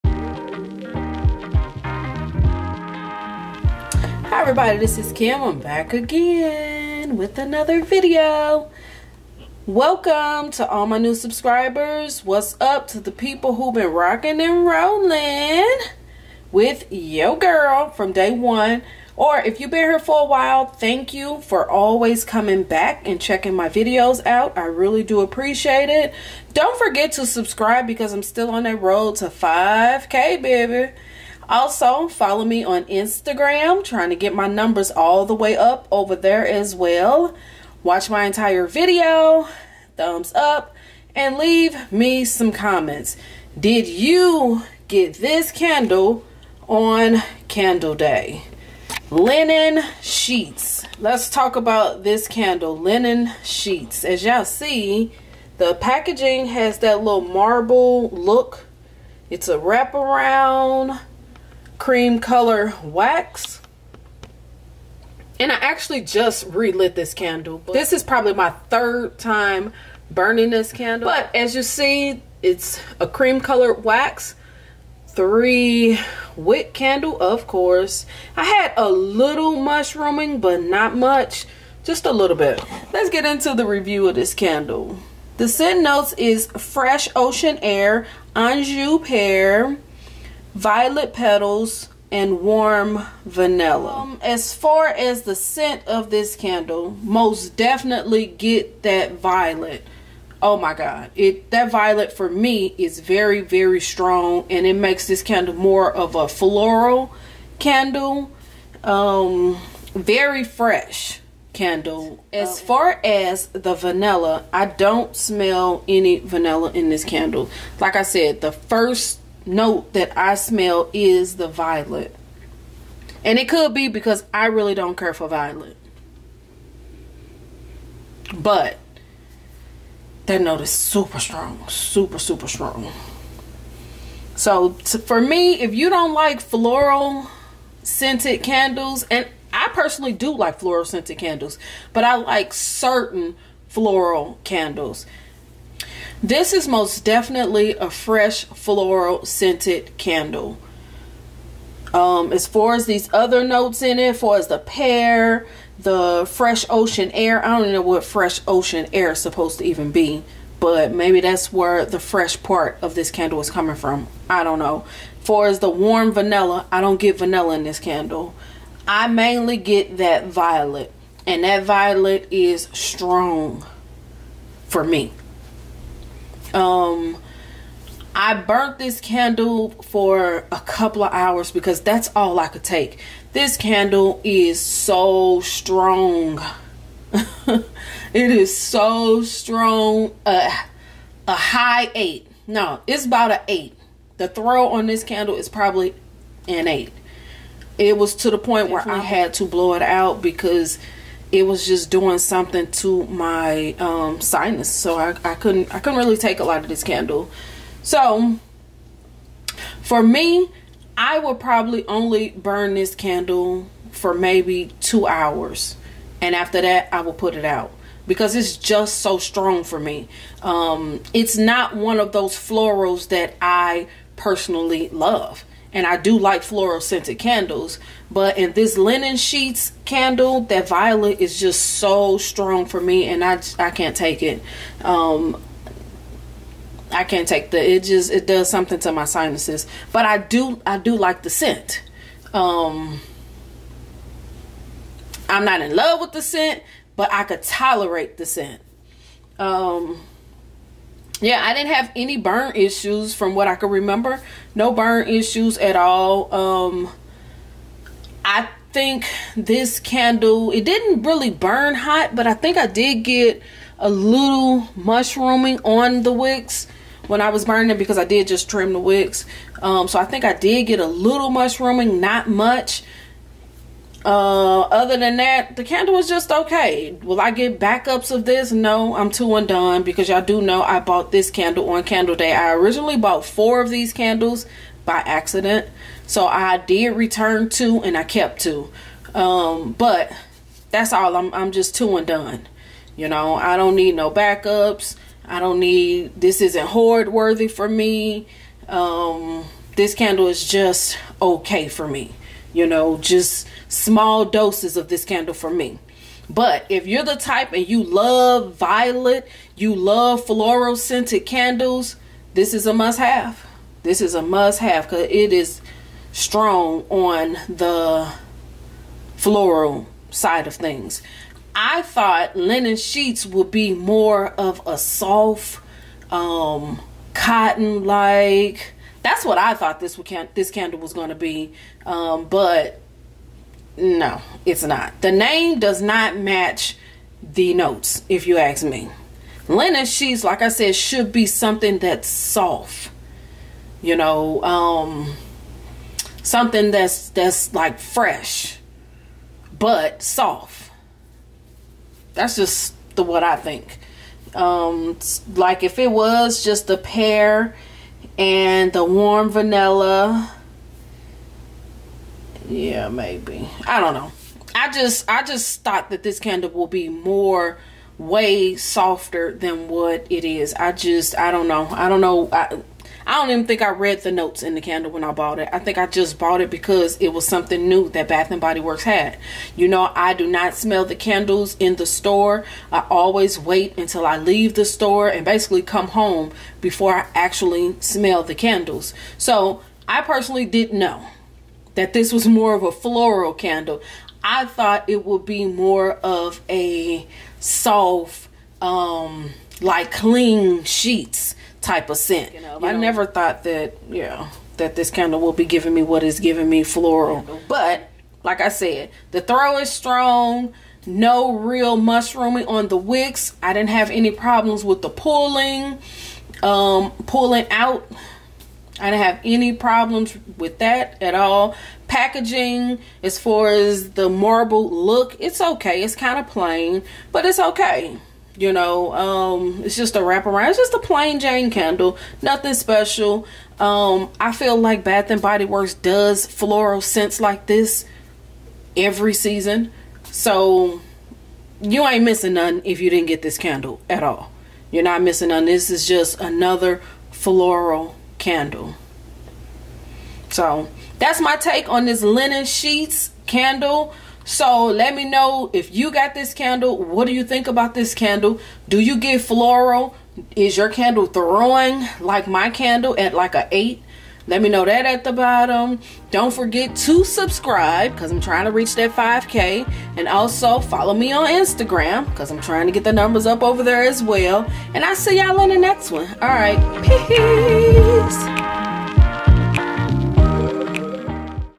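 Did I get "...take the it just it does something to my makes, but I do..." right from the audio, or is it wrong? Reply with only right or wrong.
wrong.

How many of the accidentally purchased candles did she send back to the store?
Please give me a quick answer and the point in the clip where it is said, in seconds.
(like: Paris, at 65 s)
2, at 286 s.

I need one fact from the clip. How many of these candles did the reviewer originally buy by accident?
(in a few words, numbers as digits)
4.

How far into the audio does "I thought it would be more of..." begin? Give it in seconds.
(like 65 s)
394 s.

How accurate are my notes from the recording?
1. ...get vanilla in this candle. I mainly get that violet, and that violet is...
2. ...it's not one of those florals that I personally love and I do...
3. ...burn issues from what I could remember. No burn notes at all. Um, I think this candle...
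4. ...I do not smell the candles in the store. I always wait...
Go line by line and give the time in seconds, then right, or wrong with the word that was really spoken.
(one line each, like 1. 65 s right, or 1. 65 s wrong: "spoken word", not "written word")
1. 166 s right
2. 221 s right
3. 252 s wrong: "issues", not "notes"
4. 379 s right.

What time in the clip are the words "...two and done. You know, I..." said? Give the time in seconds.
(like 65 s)
291 s.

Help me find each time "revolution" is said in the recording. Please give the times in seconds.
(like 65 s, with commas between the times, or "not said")
not said.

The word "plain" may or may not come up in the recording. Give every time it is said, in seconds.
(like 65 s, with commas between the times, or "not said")
426 s, 430 s.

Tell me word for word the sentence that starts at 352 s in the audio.
That's just the what I think.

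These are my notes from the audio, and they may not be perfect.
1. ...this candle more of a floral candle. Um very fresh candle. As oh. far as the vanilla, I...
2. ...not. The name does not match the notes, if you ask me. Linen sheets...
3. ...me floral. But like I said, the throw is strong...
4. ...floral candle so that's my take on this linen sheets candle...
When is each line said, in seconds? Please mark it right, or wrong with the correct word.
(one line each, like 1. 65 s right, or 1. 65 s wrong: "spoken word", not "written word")
1. 105 s right
2. 334 s right
3. 406 s right
4. 447 s right.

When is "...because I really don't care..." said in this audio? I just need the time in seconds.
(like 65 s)
123 s.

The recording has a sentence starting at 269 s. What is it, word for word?
Um, so I think I did get a little mushrooming, not much.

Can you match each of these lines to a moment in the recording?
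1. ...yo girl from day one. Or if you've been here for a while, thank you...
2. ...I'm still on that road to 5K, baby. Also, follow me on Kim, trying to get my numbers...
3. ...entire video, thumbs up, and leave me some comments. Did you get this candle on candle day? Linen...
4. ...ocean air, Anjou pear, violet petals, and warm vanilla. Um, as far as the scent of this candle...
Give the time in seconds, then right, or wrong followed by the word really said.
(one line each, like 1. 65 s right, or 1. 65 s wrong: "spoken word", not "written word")
1. 16 s right
2. 28 s wrong: "Instagram", not "Kim"
3. 38 s right
4. 87 s right.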